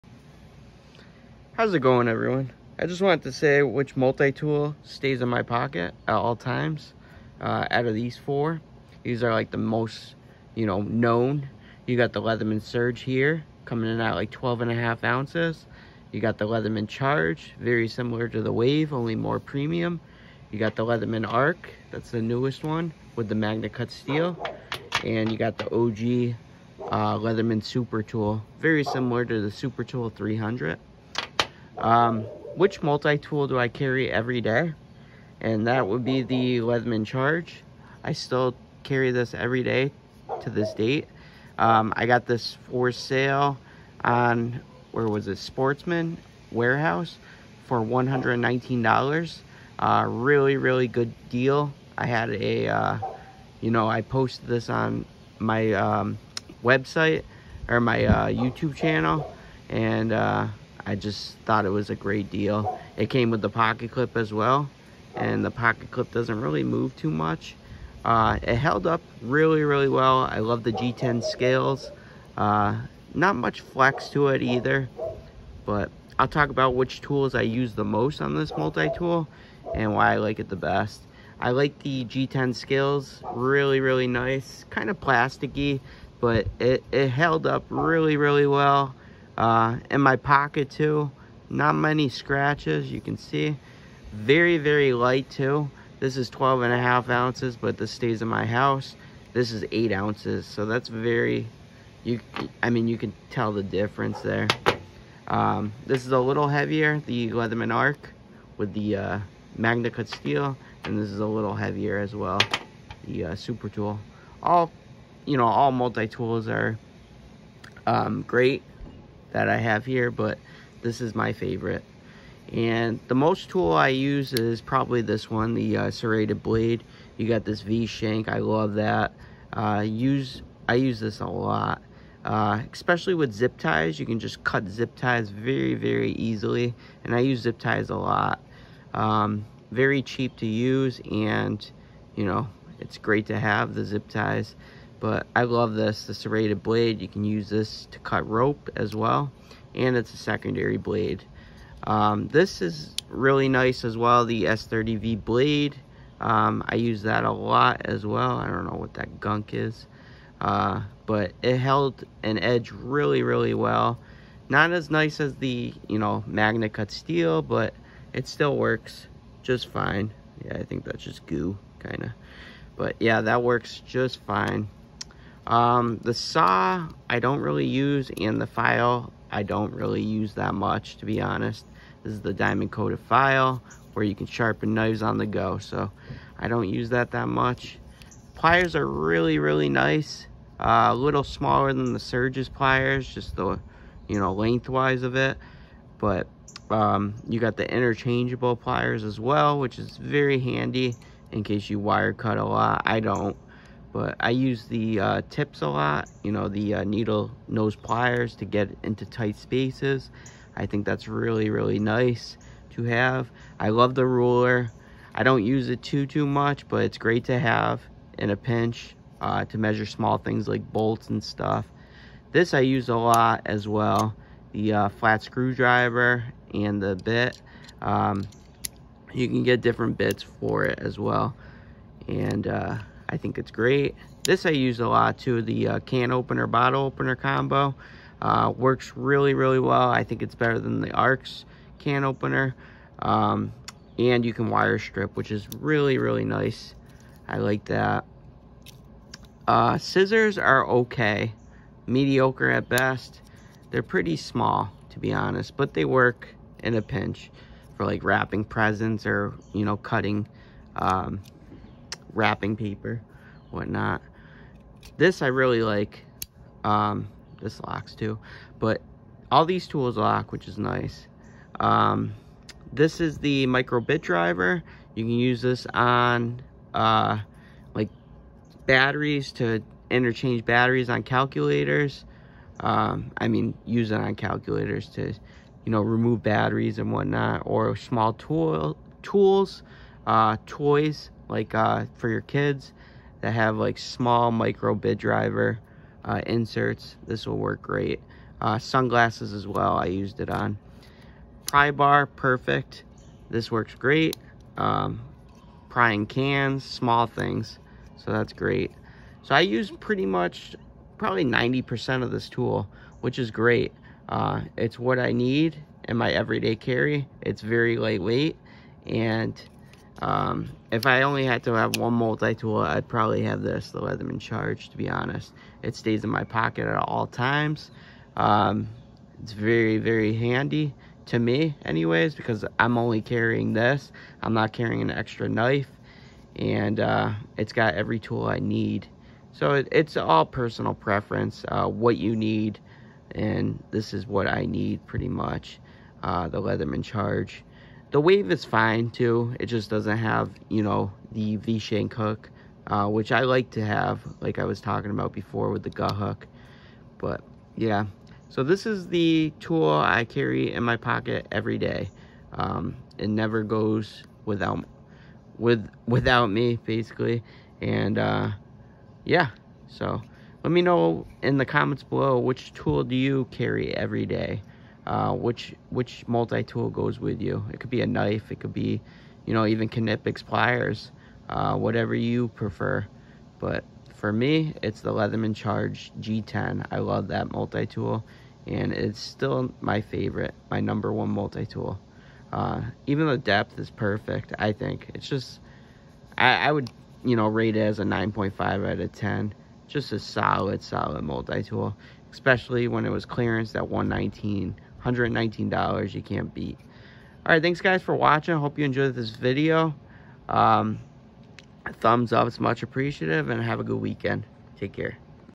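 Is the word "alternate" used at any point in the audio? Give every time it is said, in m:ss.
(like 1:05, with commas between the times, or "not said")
not said.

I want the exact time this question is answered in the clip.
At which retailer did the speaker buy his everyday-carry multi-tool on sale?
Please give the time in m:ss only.
0:45.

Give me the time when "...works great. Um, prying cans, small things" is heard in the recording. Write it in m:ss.
5:03.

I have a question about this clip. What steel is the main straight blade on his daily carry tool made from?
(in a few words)
S30V.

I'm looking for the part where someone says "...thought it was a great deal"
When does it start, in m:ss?
1:01.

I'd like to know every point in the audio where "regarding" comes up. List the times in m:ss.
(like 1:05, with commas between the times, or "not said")
not said.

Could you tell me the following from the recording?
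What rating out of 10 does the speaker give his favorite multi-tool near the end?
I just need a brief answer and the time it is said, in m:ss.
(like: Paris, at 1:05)
9.5, at 6:37.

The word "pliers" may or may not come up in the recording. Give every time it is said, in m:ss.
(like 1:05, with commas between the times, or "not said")
3:08, 3:12, 3:18, 3:27, 6:20.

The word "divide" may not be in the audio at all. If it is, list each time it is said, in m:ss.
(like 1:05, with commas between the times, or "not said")
not said.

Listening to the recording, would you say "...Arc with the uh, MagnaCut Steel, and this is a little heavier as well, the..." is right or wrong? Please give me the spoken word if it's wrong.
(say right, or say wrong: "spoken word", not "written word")
right.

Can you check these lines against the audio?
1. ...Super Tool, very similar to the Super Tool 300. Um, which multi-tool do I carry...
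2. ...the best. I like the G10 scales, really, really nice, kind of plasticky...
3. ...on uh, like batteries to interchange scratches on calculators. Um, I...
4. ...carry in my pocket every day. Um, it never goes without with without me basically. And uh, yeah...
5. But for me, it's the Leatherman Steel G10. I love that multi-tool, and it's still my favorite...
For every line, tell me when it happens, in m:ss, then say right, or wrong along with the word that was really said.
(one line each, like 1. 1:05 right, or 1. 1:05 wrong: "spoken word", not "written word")
1. 0:27 right
2. 1:20 right
3. 4:35 wrong: "batteries", not "scratches"
4. 6:00 right
5. 6:23 wrong: "Charge", not "Steel".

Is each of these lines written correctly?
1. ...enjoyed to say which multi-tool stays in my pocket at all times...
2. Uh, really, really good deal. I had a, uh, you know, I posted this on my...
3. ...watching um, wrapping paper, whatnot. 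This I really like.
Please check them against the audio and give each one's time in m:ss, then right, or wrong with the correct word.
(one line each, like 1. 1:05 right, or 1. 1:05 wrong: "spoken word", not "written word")
1. 0:03 wrong: "wanted", not "enjoyed"
2. 0:49 right
3. 4:19 wrong: "cutting", not "watching".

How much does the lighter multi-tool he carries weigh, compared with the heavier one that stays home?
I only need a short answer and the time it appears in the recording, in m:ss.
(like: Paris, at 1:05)
8 ounces, at 1:39.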